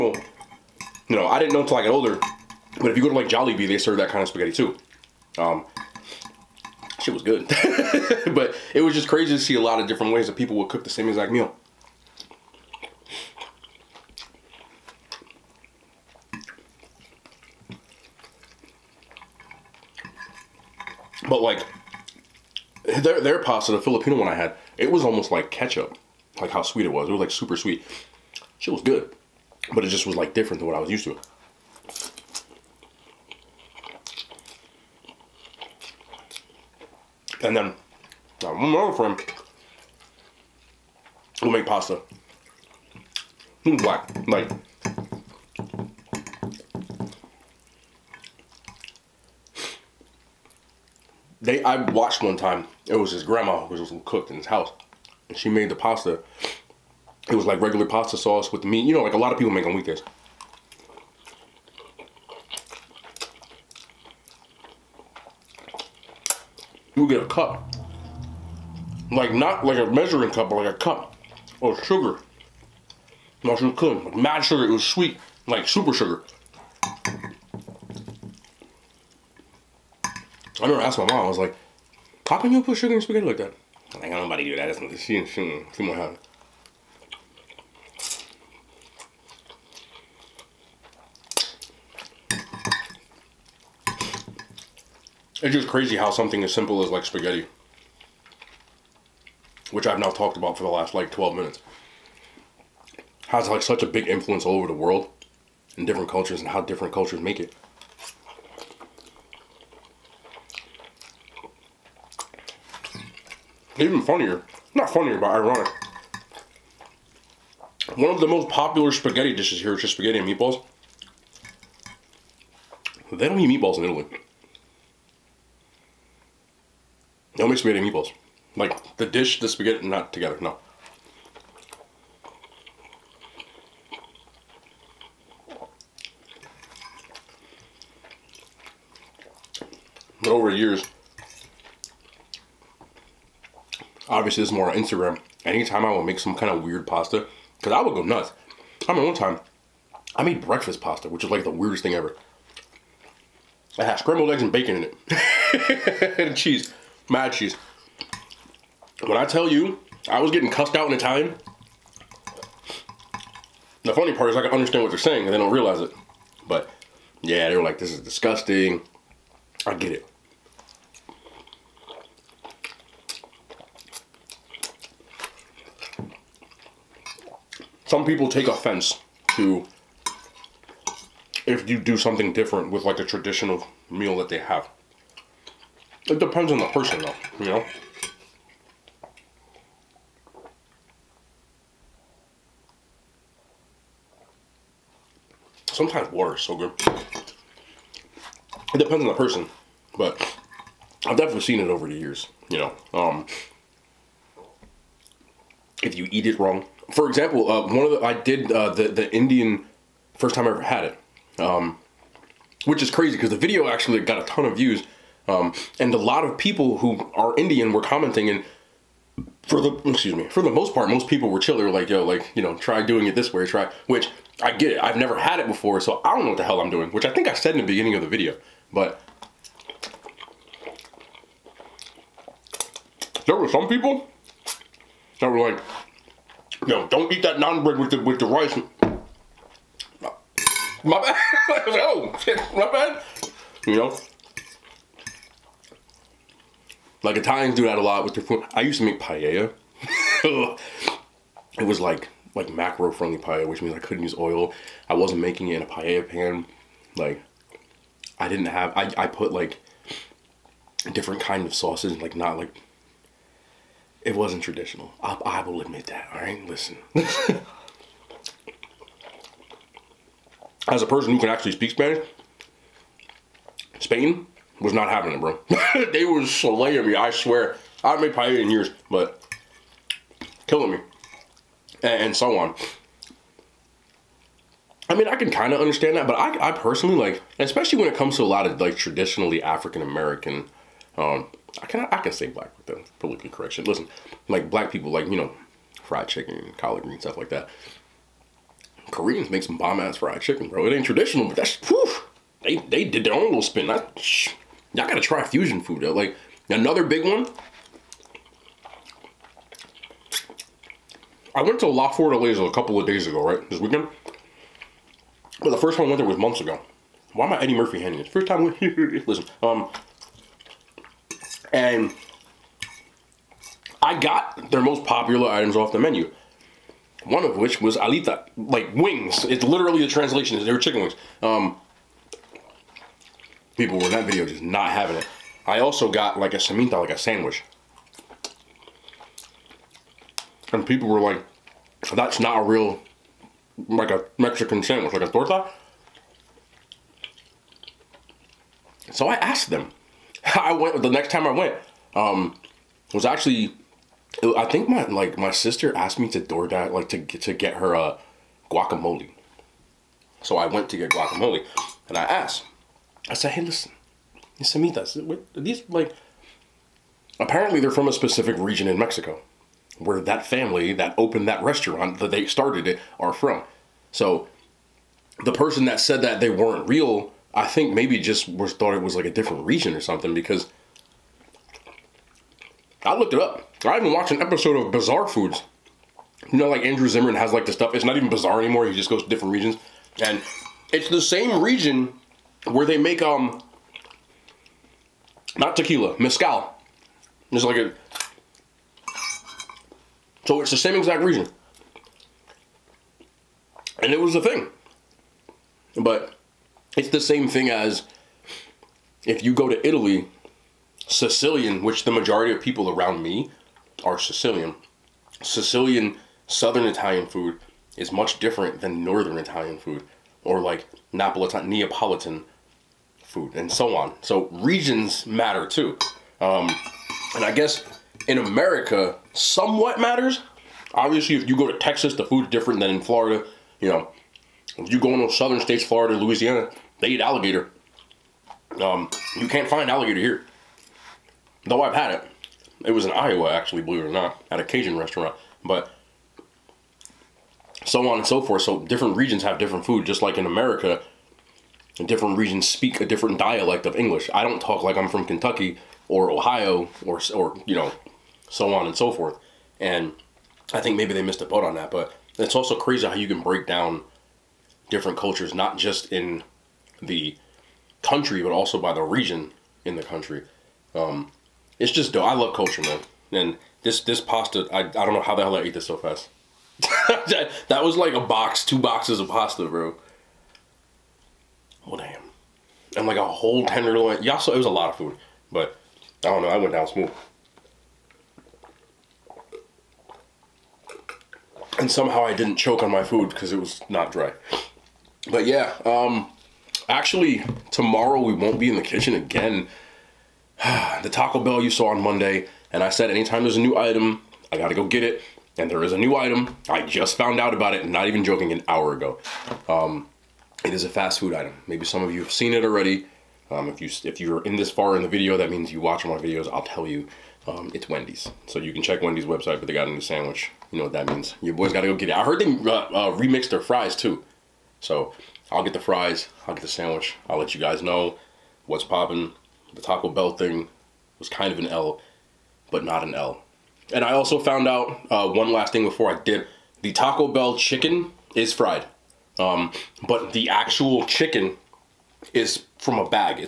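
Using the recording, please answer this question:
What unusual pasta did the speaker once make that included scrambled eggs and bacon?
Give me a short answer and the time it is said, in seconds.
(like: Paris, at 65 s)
Breakfast pasta, at 150 s.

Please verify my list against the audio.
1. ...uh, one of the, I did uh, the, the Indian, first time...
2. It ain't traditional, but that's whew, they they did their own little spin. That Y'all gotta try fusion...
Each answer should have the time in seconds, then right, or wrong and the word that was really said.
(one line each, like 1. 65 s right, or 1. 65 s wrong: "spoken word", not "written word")
1. 207 s right
2. 300 s right.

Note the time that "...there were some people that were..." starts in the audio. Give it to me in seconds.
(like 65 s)
233 s.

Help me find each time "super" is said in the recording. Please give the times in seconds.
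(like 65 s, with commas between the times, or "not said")
27 s, 75 s.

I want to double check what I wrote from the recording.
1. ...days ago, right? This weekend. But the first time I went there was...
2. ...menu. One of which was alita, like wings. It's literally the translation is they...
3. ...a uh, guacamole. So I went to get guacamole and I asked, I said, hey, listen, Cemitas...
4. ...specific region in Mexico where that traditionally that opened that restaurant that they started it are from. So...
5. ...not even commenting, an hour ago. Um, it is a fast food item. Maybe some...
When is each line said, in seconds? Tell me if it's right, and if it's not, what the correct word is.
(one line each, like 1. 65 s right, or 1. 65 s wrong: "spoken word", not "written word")
1. 312 s right
2. 325 s right
3. 357 s right
4. 367 s wrong: "family", not "traditionally"
5. 507 s wrong: "joking", not "commenting".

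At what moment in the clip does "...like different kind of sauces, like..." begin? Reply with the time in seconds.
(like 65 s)
259 s.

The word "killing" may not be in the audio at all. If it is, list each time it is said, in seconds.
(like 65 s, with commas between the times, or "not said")
280 s.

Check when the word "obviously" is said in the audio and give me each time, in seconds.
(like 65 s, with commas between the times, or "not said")
144 s, 430 s.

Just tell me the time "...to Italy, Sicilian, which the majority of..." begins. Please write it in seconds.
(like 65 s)
409 s.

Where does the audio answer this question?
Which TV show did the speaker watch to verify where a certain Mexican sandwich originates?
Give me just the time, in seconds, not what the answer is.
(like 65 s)
384 s.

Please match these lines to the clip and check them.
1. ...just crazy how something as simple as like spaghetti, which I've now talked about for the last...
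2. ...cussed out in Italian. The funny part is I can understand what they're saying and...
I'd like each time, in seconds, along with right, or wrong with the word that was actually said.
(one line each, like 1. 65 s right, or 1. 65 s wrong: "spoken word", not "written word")
1. 95 s right
2. 160 s right.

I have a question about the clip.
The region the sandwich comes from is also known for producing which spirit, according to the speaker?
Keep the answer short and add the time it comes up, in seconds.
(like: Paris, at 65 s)
Mezcal, at 395 s.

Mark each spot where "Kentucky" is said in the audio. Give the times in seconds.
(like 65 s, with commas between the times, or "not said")
455 s.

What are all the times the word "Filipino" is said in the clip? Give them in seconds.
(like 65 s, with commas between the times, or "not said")
23 s.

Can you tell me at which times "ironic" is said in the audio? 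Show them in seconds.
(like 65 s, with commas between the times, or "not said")
115 s.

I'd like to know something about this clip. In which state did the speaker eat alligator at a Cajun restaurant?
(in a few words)
Iowa.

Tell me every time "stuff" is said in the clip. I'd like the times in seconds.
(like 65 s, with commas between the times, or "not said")
297 s, 387 s.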